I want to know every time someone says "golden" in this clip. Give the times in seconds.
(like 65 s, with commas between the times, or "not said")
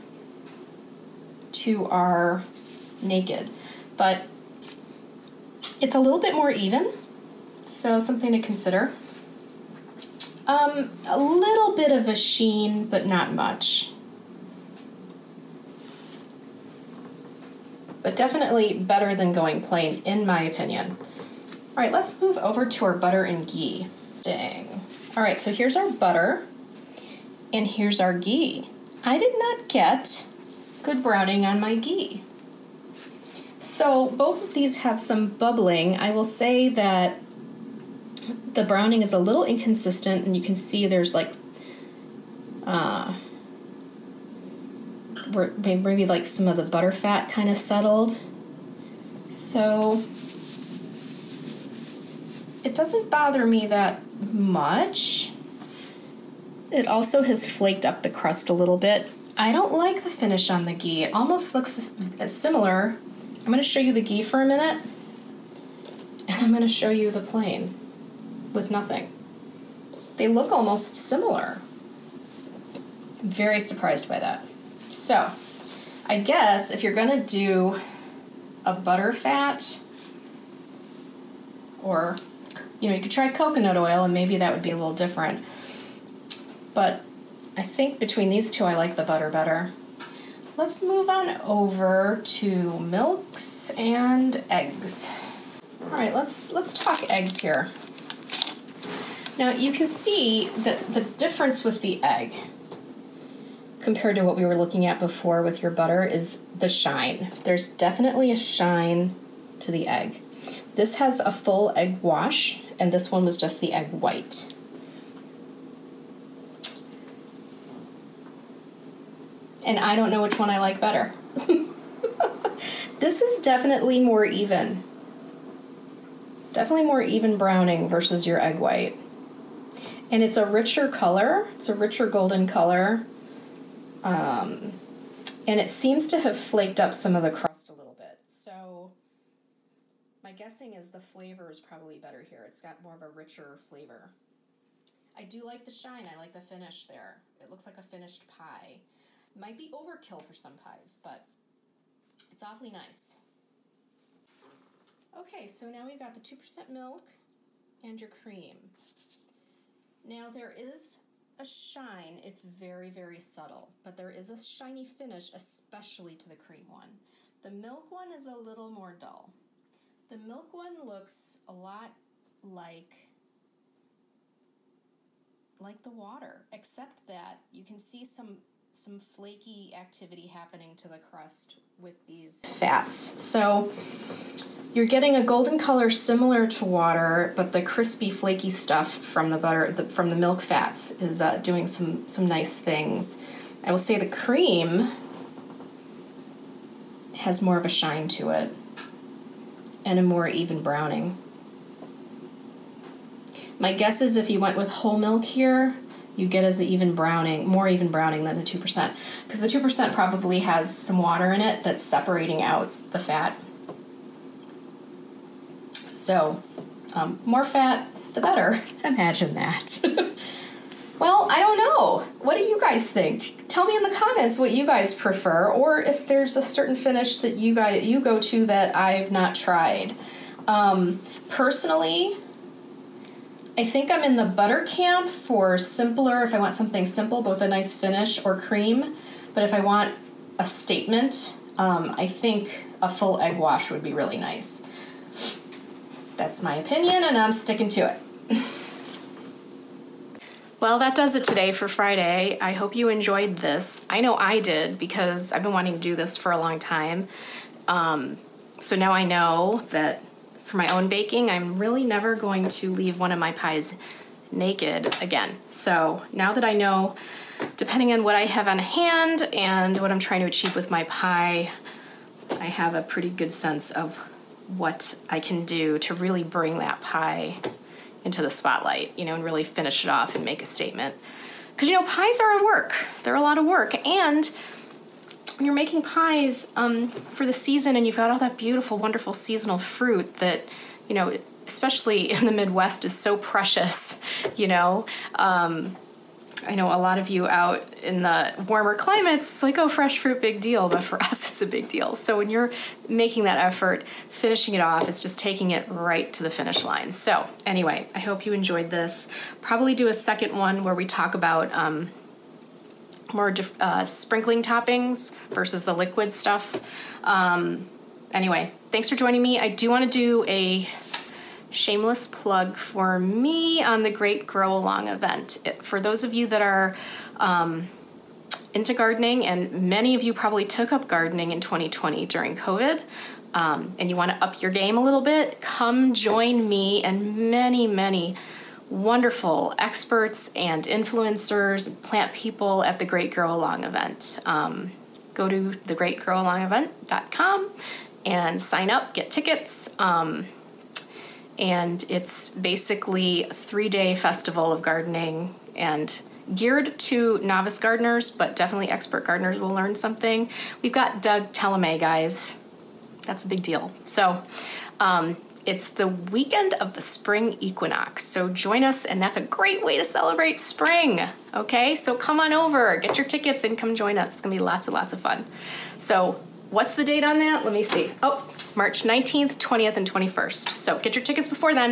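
132 s, 185 s.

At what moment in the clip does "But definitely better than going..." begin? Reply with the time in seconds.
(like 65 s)
18 s.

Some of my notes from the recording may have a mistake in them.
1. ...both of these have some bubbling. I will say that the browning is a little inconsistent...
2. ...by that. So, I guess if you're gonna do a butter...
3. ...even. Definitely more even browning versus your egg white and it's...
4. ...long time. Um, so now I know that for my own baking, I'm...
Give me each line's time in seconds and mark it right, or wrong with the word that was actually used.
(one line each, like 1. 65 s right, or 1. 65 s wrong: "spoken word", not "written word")
1. 34 s right
2. 74 s right
3. 124 s right
4. 256 s right.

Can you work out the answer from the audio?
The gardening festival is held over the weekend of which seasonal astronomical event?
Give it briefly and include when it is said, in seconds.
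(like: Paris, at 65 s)
Spring equinox, at 366 s.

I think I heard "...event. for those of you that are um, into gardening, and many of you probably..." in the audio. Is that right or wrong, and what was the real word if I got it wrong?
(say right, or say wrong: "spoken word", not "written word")
right.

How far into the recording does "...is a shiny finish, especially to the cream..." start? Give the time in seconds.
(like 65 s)
164 s.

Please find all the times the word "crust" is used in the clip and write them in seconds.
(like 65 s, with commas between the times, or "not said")
58 s, 137 s, 180 s.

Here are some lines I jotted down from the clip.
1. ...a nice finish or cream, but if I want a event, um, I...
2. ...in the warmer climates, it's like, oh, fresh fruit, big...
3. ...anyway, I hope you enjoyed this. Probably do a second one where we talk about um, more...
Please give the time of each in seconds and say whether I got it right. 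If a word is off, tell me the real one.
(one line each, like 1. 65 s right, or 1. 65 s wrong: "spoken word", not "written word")
1. 237 s wrong: "statement", not "event"
2. 297 s right
3. 307 s right.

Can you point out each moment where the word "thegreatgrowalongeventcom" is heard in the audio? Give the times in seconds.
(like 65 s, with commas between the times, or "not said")
345 s.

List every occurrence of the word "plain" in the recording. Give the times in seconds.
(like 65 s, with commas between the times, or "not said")
19 s, 67 s.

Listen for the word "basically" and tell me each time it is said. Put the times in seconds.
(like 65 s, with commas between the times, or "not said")
352 s.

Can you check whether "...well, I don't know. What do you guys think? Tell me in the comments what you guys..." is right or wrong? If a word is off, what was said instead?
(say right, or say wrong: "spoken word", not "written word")
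right.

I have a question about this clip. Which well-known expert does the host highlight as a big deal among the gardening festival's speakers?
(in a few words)
Doug Tallamy.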